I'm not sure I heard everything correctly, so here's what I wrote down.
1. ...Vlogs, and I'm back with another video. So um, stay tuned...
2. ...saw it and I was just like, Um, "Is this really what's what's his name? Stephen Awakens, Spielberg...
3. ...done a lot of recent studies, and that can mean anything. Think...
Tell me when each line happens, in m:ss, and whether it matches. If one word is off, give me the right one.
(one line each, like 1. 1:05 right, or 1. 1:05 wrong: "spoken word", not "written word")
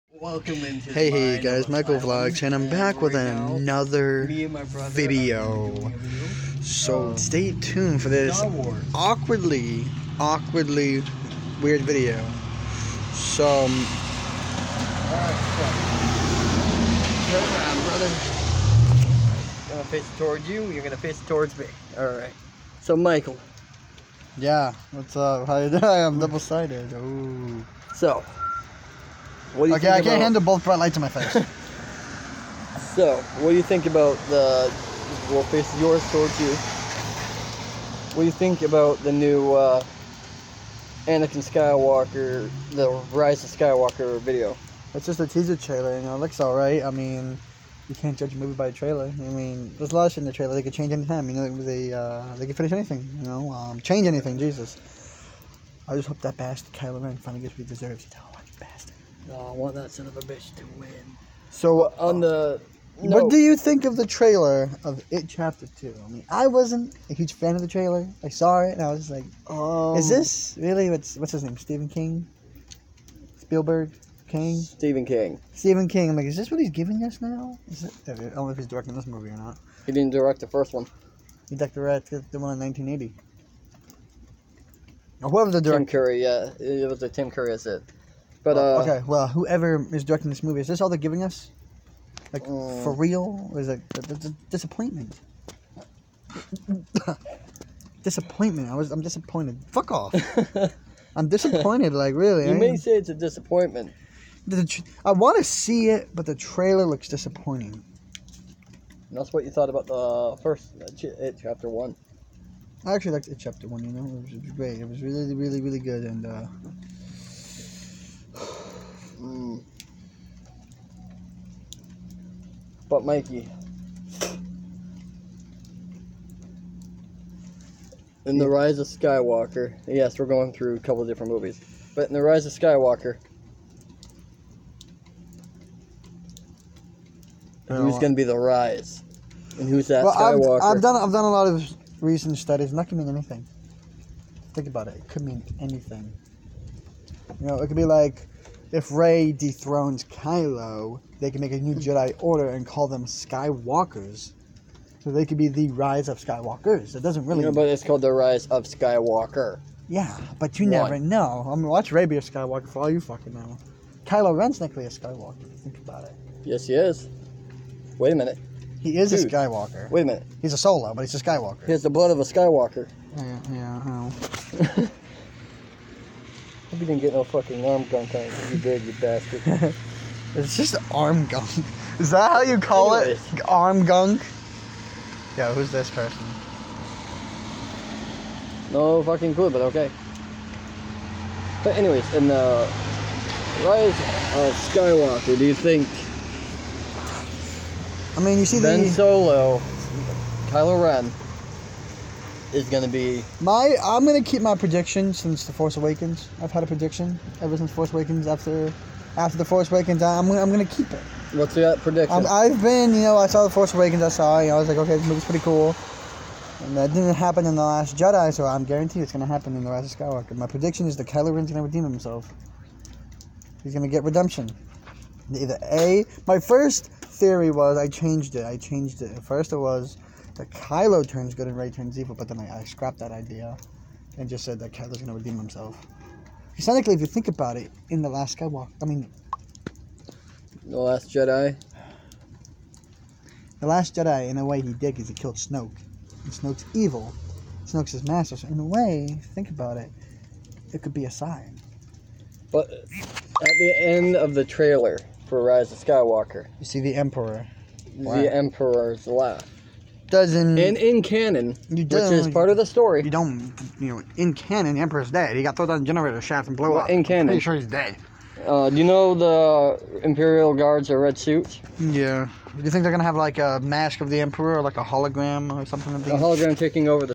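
1. 0:01 right
2. 1:08 wrong: "King", not "Awakens"
3. 2:21 right.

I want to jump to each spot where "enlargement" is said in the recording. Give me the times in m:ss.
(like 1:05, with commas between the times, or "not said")
not said.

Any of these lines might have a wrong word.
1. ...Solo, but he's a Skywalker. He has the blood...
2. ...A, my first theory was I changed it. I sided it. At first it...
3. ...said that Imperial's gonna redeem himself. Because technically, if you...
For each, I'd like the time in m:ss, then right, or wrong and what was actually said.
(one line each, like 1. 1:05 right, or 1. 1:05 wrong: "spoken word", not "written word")
1. 2:50 right
2. 3:45 wrong: "changed", not "sided"
3. 3:54 wrong: "Kylo", not "Imperial".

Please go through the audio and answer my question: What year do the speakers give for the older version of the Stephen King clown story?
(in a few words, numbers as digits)
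1980.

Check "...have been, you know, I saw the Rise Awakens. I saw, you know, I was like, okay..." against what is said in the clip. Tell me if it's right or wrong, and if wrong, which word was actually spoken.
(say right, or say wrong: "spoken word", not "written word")
wrong: "Force", not "Rise".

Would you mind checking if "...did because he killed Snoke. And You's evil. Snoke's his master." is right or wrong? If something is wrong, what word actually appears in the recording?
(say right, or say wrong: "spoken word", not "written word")
wrong: "Snoke", not "You".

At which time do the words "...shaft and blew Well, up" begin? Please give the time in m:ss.
4:26.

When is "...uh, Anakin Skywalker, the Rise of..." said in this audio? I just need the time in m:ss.
0:39.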